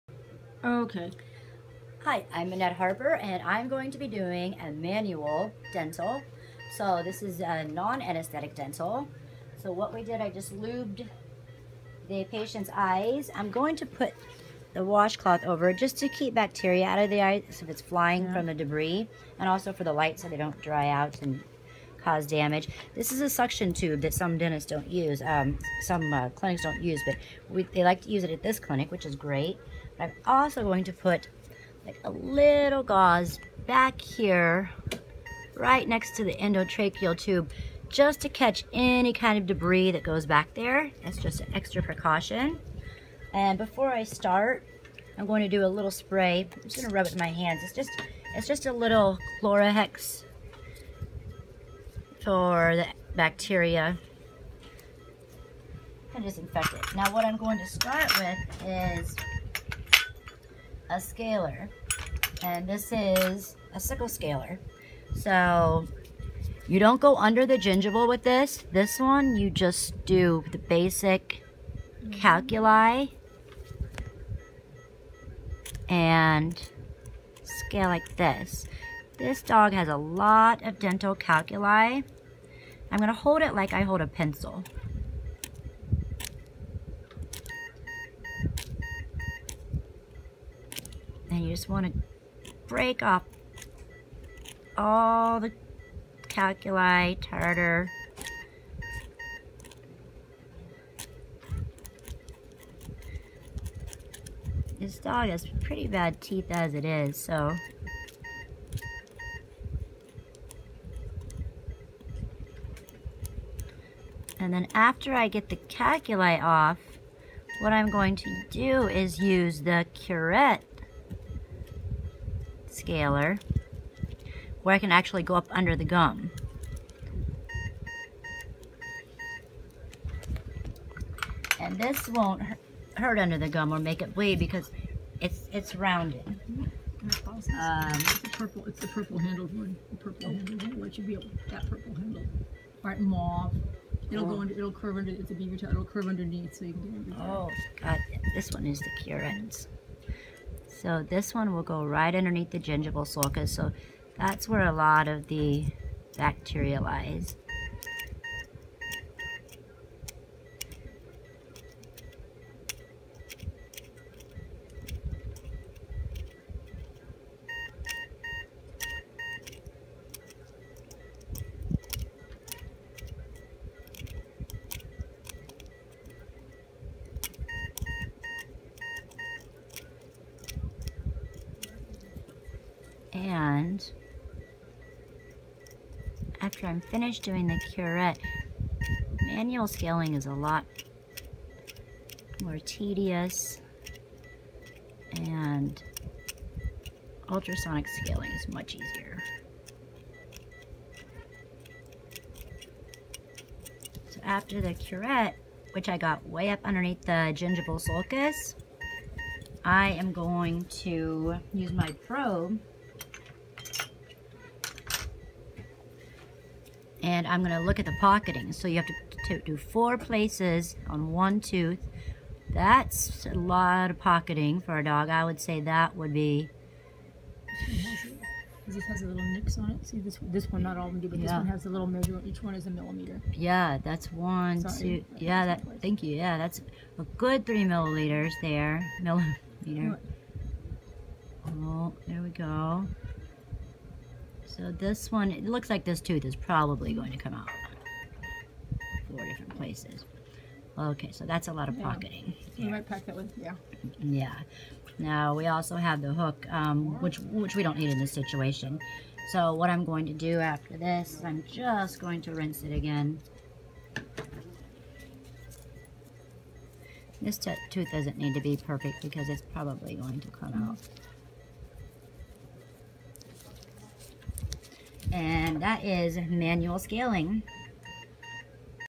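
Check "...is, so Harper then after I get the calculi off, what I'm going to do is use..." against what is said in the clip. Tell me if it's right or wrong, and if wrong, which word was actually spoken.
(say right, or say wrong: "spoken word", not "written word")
wrong: "And", not "Harper".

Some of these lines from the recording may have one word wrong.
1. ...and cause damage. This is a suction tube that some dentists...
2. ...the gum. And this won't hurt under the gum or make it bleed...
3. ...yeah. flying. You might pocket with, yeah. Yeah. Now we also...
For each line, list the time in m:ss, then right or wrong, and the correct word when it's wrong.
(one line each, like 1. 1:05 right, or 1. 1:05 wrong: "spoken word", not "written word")
1. 0:21 right
2. 2:05 right
3. 4:11 wrong: "pocketing", not "flying".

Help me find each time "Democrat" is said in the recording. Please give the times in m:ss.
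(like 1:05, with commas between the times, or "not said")
not said.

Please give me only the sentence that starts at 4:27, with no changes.
This tooth doesn't need to be perfect because it's probably going to come out.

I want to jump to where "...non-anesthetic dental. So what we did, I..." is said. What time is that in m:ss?
0:07.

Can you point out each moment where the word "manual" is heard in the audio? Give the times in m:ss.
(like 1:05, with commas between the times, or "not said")
0:04, 3:09, 4:36.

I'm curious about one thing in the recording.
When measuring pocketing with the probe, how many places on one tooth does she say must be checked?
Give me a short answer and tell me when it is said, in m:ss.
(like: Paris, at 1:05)
4, at 3:39.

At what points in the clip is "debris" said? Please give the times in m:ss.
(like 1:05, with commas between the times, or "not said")
0:18, 0:39.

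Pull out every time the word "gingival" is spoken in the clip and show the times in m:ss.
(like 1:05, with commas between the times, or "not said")
1:07, 2:32, 3:27.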